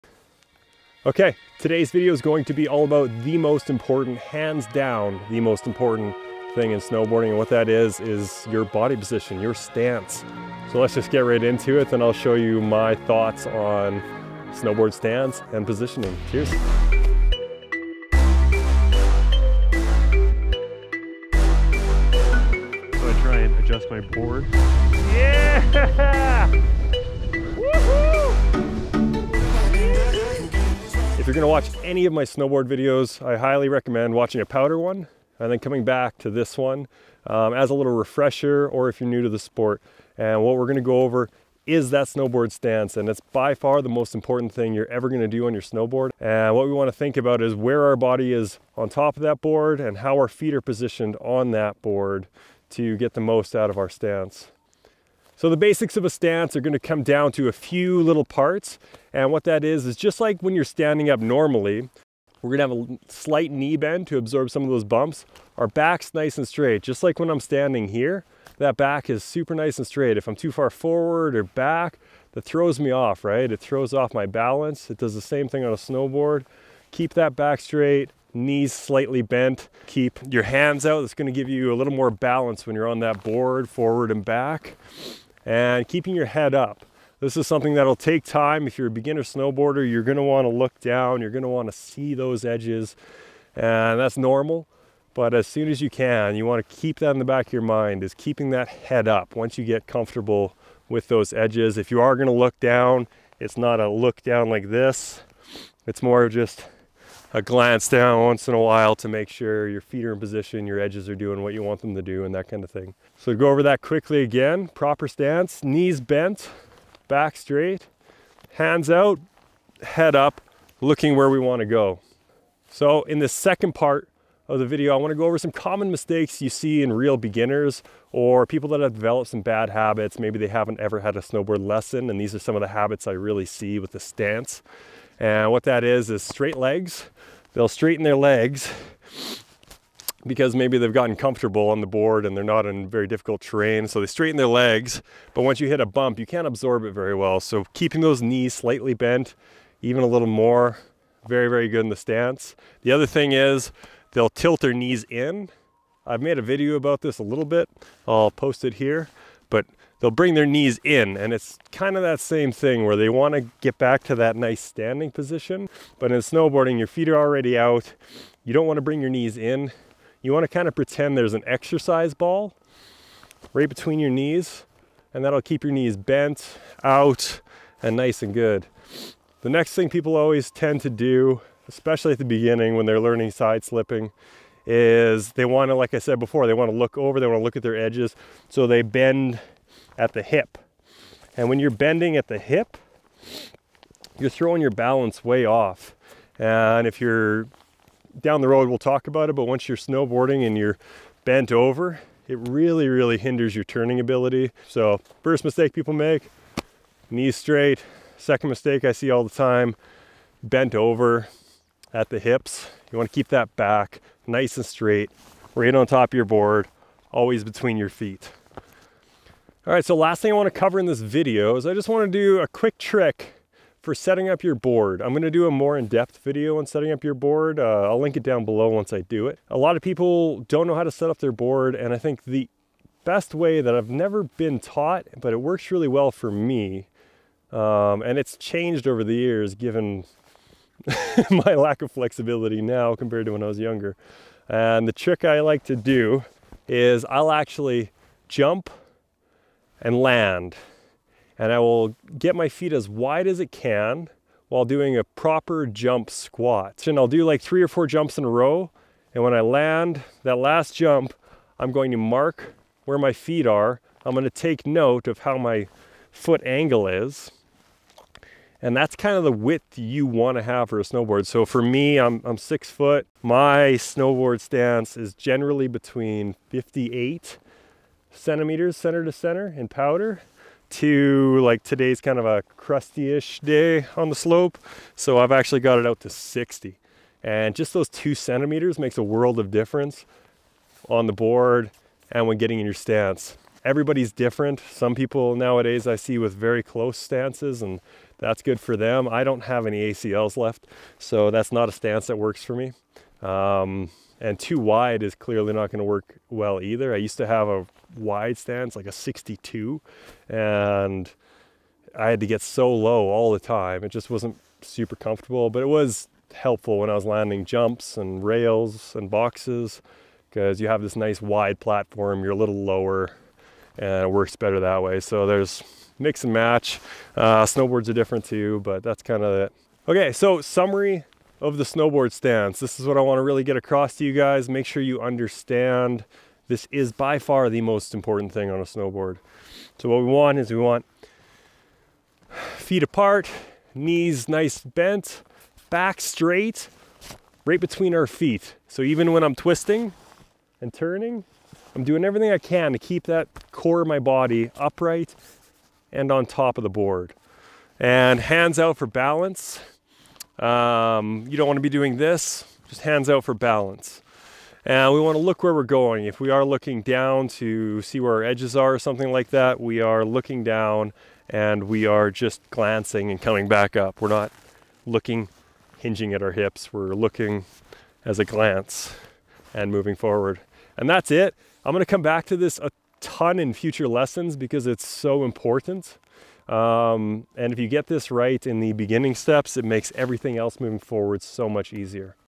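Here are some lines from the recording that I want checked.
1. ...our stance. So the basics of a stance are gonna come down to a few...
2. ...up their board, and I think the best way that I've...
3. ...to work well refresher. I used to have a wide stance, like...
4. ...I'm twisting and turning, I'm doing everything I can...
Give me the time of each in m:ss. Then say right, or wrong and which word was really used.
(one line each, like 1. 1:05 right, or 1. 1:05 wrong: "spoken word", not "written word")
1. 0:53 right
2. 3:51 right
3. 5:05 wrong: "either", not "refresher"
4. 5:49 right.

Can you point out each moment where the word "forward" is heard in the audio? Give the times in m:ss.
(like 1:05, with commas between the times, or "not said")
1:10, 1:23, 6:19, 6:30.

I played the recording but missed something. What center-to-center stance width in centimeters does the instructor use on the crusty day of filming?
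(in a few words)
60.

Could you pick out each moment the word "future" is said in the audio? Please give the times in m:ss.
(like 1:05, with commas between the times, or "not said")
6:23.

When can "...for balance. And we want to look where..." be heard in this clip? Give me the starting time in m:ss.
6:03.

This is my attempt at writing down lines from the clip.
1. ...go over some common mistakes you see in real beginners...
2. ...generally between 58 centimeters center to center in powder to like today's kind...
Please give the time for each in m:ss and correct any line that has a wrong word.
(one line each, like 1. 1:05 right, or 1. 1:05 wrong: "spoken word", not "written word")
1. 2:05 right
2. 4:35 right.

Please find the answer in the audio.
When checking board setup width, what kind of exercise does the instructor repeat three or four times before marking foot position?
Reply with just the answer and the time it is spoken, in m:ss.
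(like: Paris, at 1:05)
Jump squat, at 4:15.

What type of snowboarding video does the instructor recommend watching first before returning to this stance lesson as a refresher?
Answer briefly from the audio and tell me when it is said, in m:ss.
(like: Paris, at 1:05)
A powder one, at 0:34.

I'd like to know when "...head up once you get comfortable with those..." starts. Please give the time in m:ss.
1:38.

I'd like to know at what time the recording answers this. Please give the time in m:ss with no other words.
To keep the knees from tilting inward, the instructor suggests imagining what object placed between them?
2:51.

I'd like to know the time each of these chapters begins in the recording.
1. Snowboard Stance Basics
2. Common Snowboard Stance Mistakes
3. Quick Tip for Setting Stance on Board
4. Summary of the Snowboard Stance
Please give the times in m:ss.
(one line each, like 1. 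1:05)
1. 0:40
2. 1:54
3. 3:39
4. 5:29.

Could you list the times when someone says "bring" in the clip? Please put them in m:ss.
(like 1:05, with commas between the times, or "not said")
2:40, 2:48.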